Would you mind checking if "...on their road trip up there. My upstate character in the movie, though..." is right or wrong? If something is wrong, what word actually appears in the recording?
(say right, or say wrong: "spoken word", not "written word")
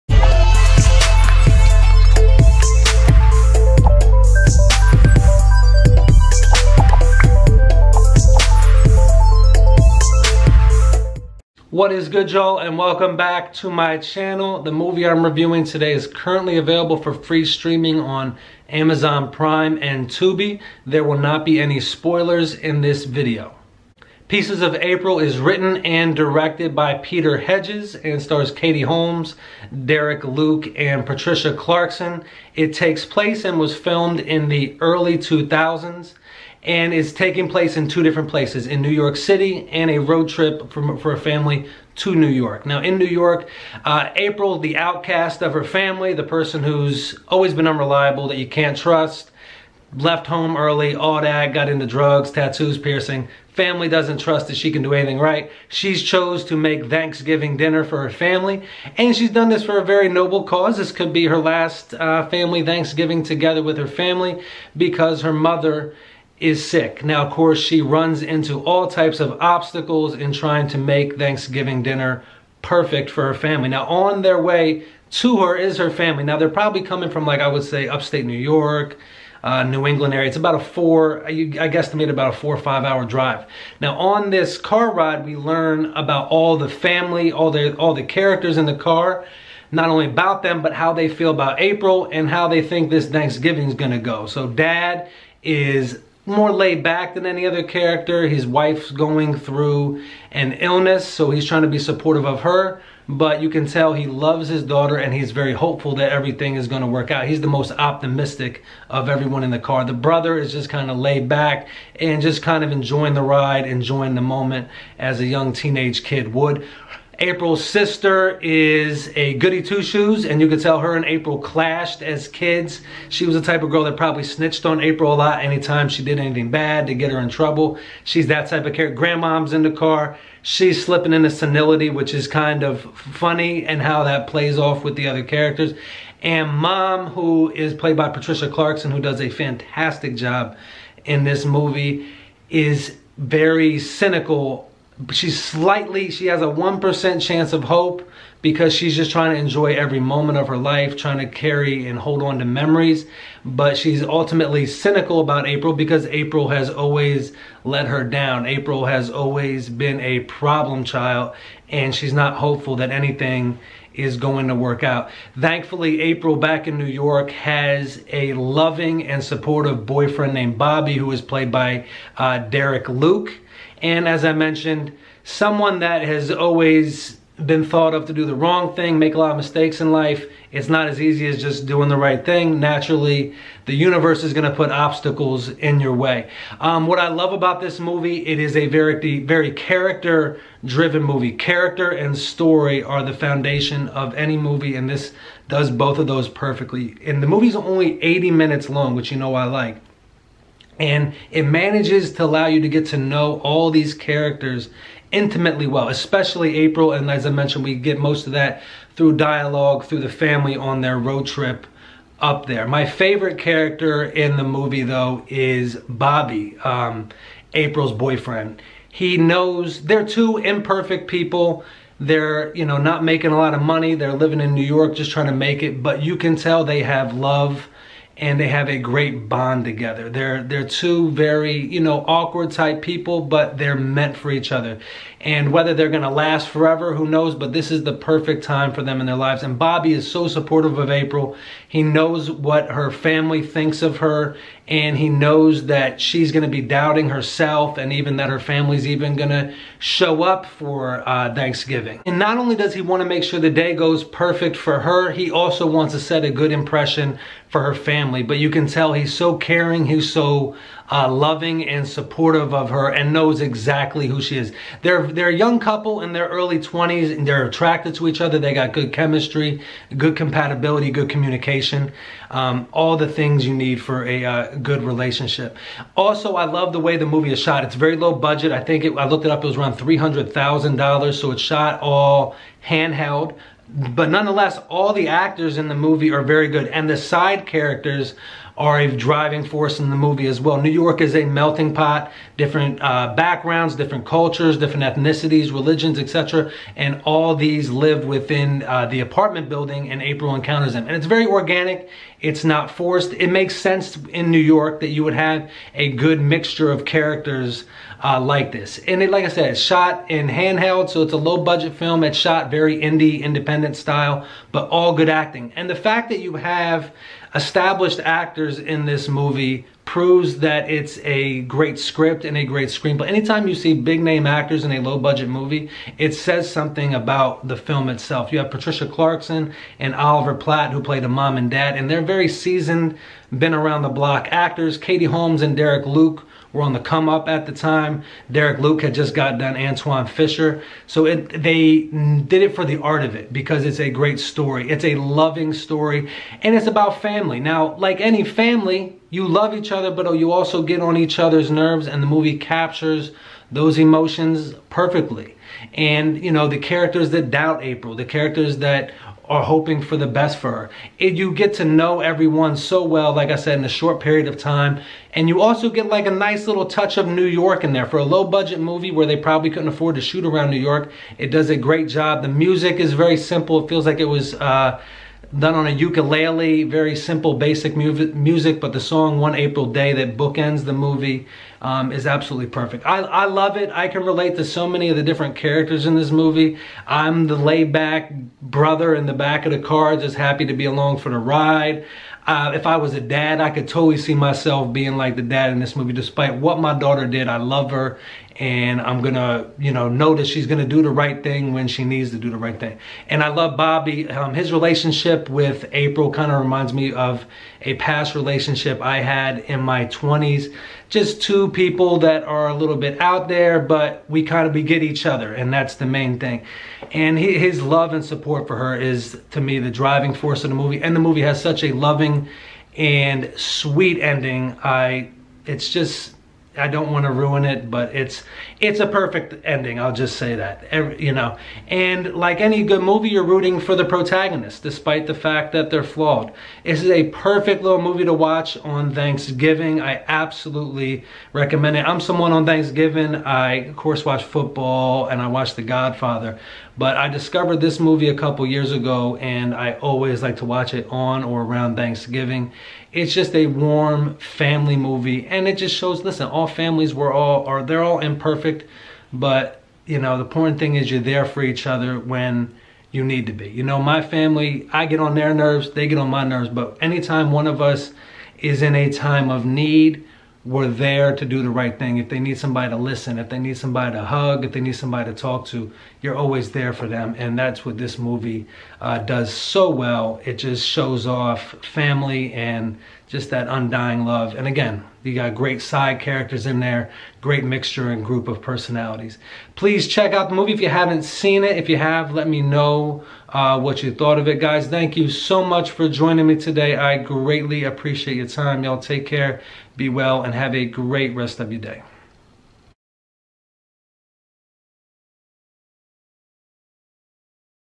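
wrong: "favorite", not "upstate".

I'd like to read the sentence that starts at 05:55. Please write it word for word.
And, you know, the characters that doubt April, the characters that are hoping for the best for her.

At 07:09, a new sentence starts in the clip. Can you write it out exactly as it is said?
I'll just say that, Every, you know.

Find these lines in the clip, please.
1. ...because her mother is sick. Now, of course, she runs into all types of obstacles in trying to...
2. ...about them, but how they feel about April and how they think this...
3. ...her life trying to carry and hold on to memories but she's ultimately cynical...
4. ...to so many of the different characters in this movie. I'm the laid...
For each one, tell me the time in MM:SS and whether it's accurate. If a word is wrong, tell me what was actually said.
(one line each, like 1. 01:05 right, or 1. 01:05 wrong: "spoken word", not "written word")
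1. 01:04 right
2. 01:30 right
3. 02:30 right
4. 06:24 right.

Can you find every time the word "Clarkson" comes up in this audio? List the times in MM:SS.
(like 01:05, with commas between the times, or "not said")
00:31, 02:18, 05:28.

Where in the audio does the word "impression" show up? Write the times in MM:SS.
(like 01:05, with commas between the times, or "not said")
04:16.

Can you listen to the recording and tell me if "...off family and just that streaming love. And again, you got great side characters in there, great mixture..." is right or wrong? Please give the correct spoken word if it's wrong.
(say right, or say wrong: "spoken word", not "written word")
wrong: "undying", not "streaming".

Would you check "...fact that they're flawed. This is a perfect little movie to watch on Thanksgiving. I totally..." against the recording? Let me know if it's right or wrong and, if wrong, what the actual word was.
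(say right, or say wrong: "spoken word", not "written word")
wrong: "absolutely", not "totally".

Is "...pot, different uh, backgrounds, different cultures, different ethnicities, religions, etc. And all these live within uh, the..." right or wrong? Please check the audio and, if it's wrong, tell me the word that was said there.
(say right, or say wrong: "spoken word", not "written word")
right.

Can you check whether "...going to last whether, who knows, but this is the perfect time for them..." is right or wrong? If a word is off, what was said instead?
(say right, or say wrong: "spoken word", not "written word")
wrong: "forever", not "whether".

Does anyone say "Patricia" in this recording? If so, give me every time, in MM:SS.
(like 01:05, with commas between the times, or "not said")
00:31, 02:18, 05:28.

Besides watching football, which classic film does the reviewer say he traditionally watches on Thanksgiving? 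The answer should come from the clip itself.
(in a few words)
The Godfather.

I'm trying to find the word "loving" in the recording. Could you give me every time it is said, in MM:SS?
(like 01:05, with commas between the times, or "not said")
02:48, 04:21, 05:44, 07:01.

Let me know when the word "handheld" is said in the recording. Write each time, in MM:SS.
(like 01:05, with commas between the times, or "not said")
04:42, 05:10.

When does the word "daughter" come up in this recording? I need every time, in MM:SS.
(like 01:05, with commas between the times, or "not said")
01:44, 06:36.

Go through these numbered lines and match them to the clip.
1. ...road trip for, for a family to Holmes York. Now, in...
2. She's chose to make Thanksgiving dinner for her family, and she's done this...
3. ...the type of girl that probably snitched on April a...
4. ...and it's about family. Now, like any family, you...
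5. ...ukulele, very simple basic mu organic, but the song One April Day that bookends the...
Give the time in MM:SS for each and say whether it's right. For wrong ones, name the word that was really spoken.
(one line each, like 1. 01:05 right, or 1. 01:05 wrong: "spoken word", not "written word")
1. 00:39 wrong: "New", not "Holmes"
2. 00:55 right
3. 02:03 right
4. 05:46 right
5. 06:15 wrong: "music", not "organic".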